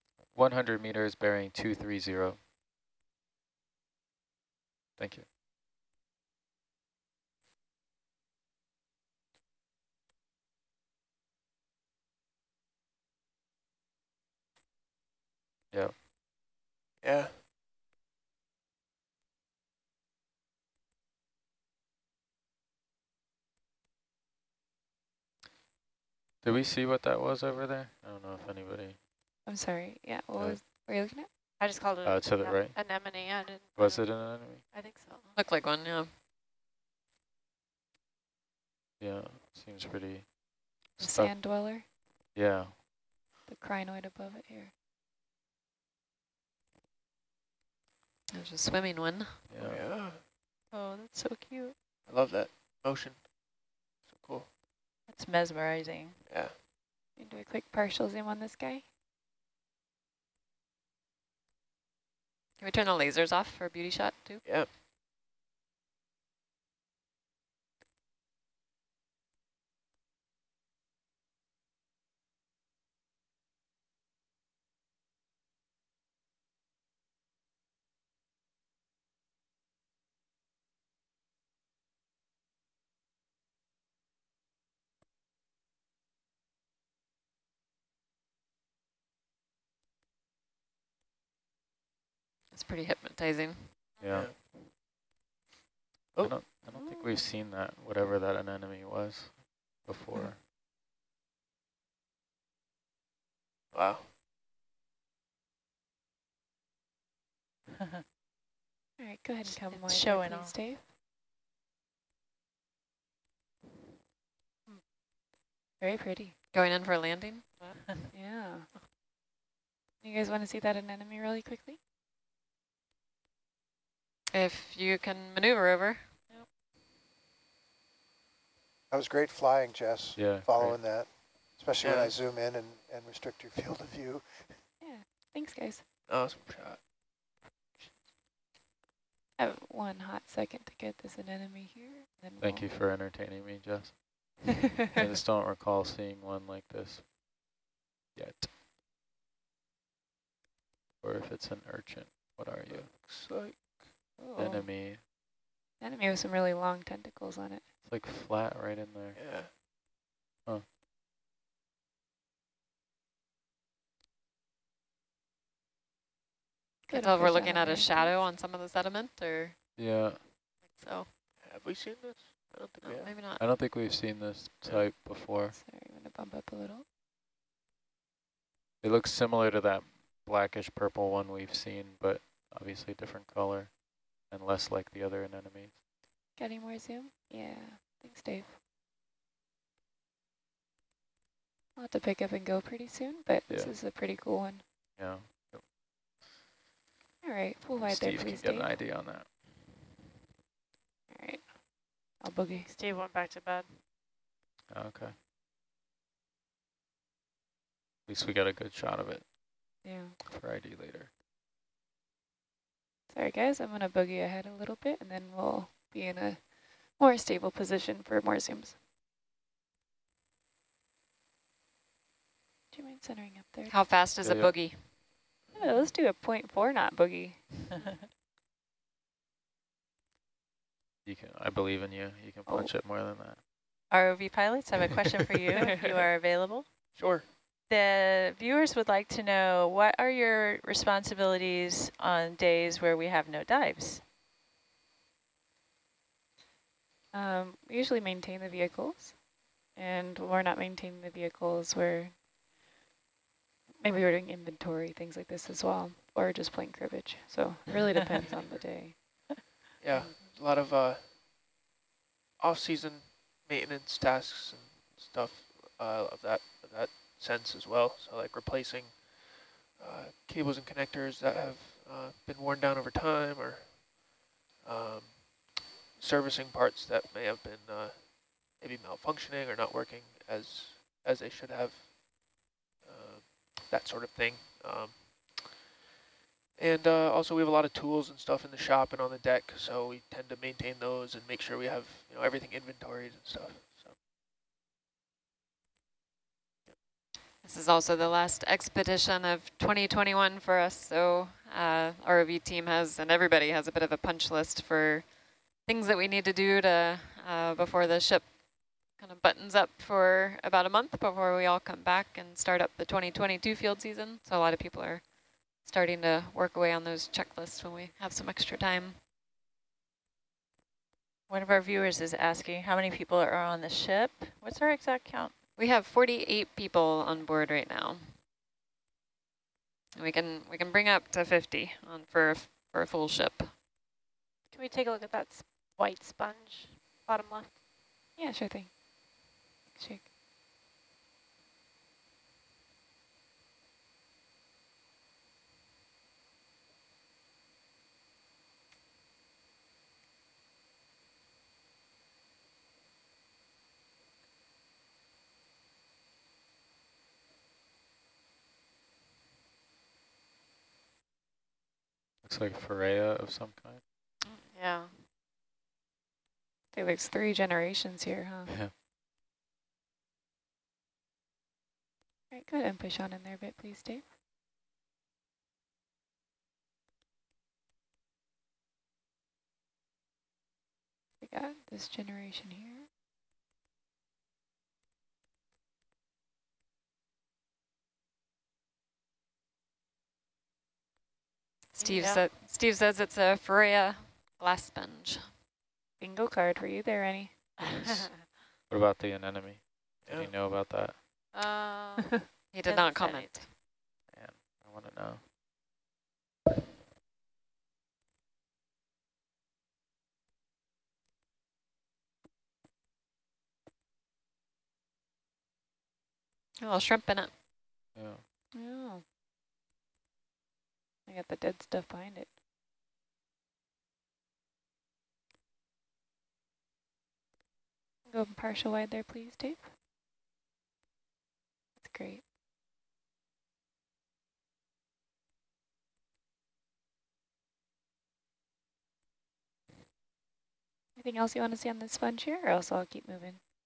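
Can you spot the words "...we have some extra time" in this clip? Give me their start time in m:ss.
5:17.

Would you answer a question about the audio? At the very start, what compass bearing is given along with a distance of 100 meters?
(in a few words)
230.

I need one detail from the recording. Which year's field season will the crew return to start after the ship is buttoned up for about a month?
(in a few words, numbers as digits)
2022.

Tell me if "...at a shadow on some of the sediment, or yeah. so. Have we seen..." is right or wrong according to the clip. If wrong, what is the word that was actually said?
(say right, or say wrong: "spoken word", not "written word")
right.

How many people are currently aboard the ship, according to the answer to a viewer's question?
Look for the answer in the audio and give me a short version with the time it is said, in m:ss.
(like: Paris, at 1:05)
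48, at 5:25.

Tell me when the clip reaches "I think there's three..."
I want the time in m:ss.
6:04.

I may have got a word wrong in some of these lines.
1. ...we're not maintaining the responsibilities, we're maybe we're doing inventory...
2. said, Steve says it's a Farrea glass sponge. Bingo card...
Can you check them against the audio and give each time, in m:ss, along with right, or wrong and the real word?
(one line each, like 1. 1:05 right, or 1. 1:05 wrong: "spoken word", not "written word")
1. 4:10 wrong: "vehicles", not "responsibilities"
2. 6:32 right.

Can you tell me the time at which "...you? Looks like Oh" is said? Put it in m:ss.
2:32.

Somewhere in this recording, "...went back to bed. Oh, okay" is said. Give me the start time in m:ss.
3:22.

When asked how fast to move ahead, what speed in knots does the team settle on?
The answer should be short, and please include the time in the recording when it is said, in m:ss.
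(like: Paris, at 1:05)
0.4 knot, at 3:46.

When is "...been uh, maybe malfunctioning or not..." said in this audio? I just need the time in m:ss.
4:37.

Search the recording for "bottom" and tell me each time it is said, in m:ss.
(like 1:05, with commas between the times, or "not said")
5:37.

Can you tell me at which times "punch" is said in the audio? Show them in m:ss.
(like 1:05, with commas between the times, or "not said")
3:52, 5:03.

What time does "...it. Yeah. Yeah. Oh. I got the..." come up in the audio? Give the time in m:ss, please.
6:57.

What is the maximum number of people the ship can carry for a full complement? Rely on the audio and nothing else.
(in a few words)
50.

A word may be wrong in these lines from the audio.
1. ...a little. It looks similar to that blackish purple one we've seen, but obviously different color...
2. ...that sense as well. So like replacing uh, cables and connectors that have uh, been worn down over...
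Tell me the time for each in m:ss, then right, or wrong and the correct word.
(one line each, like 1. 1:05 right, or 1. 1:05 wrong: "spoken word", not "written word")
1. 2:56 right
2. 4:26 right.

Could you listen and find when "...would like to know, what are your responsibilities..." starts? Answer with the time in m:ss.
3:58.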